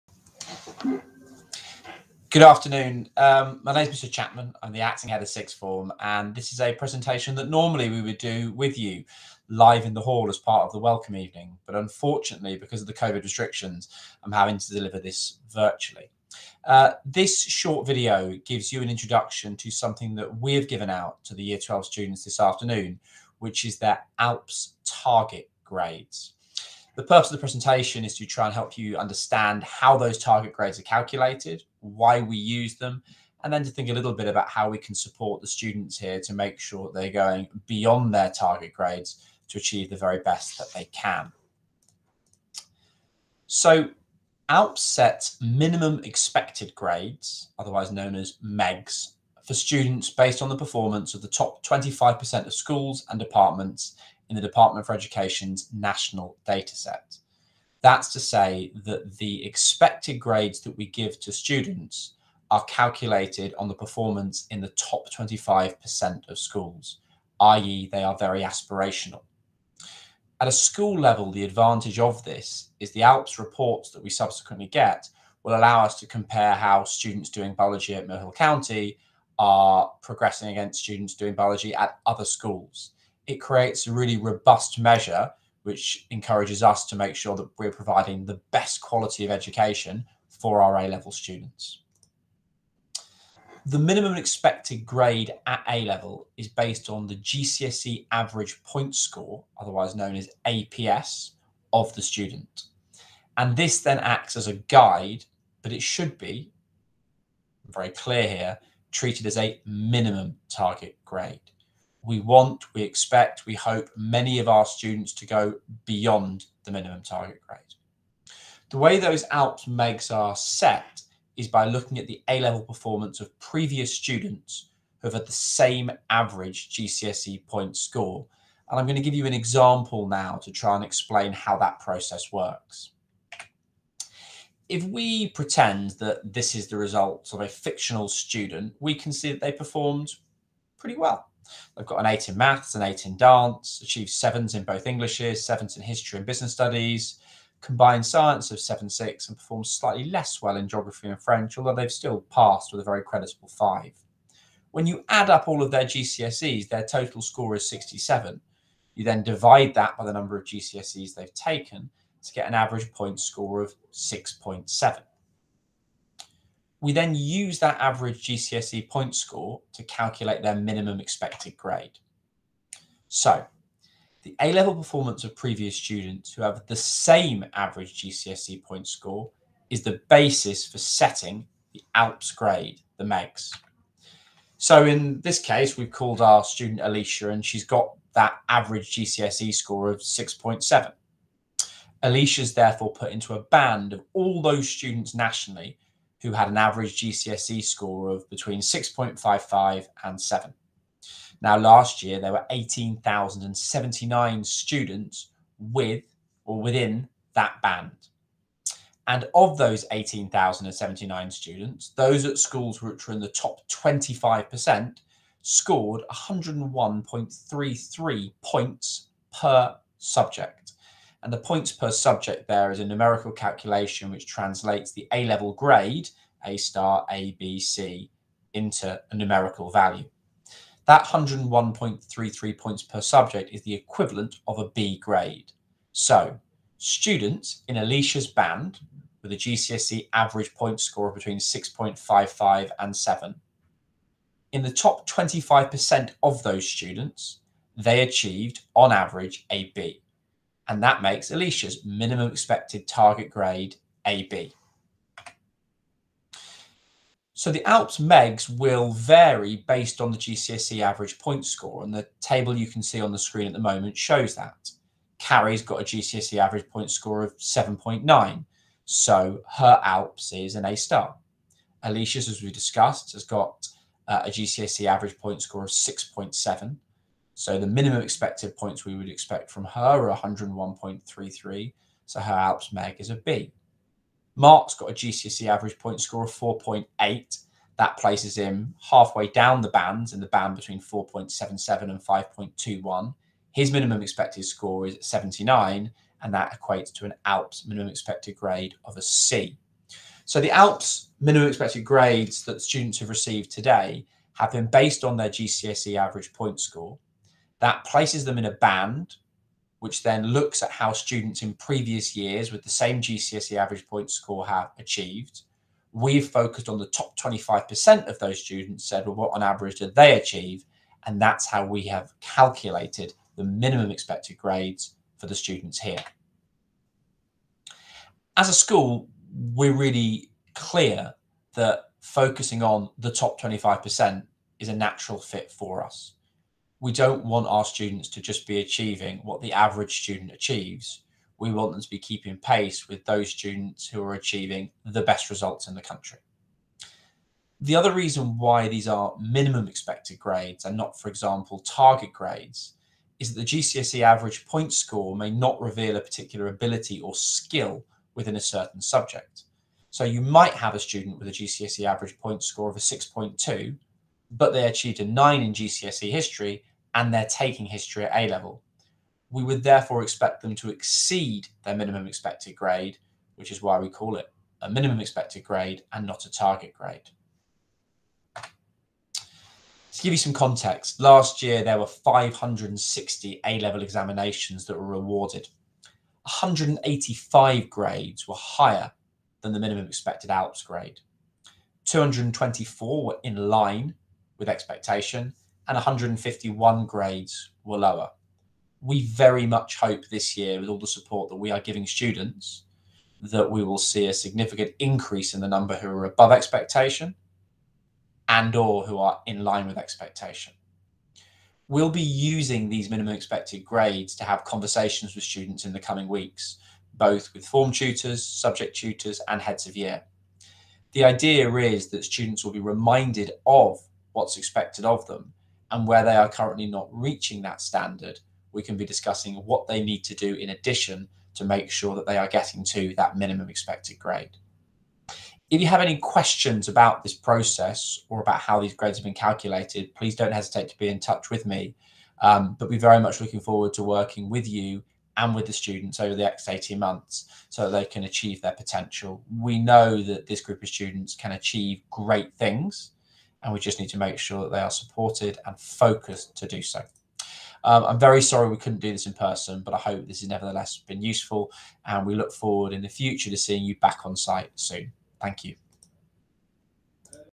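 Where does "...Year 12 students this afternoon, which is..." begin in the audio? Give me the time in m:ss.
0:21.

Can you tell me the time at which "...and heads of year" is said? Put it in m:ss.
6:59.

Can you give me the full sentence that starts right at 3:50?
That 101.33 points per subject is the equivalent of a B grade.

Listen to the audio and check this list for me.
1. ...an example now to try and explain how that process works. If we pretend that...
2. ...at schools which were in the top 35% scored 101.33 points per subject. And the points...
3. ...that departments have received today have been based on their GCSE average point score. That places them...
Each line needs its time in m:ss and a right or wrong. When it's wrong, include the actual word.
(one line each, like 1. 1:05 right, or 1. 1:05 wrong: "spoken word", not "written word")
1. 2:09 right
2. 3:32 wrong: "25", not "35"
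3. 5:02 wrong: "students", not "departments".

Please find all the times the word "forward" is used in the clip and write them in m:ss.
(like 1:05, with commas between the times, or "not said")
7:23, 7:42.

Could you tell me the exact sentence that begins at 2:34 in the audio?
When you add up all of their GCSEs, their total score is 67.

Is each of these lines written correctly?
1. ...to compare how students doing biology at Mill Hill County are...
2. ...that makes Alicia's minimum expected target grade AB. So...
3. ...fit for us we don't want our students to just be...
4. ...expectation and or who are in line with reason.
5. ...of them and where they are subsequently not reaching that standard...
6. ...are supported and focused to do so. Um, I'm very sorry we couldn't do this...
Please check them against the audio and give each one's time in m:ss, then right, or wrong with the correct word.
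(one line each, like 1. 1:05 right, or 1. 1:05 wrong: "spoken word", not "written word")
1. 1:15 right
2. 4:10 right
3. 5:35 right
4. 6:46 wrong: "expectation", not "reason"
5. 7:04 wrong: "currently", not "subsequently"
6. 7:34 right.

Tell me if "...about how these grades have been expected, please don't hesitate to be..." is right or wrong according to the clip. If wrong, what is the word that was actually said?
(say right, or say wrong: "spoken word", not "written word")
wrong: "calculated", not "expected".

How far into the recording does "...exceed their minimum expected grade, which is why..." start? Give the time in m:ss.
6:10.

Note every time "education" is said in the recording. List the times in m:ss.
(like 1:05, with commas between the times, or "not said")
0:54, 1:29.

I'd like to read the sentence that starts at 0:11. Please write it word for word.
But unfortunately, because of the COVID restrictions, I'm having to deliver this virtually.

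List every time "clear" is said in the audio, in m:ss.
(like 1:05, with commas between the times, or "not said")
1:47, 5:30.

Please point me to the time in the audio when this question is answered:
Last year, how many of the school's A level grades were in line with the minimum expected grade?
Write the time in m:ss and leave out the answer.
6:31.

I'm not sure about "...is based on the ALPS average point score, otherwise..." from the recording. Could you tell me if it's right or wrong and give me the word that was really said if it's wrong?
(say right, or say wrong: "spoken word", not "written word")
wrong: "GCSE", not "ALPS".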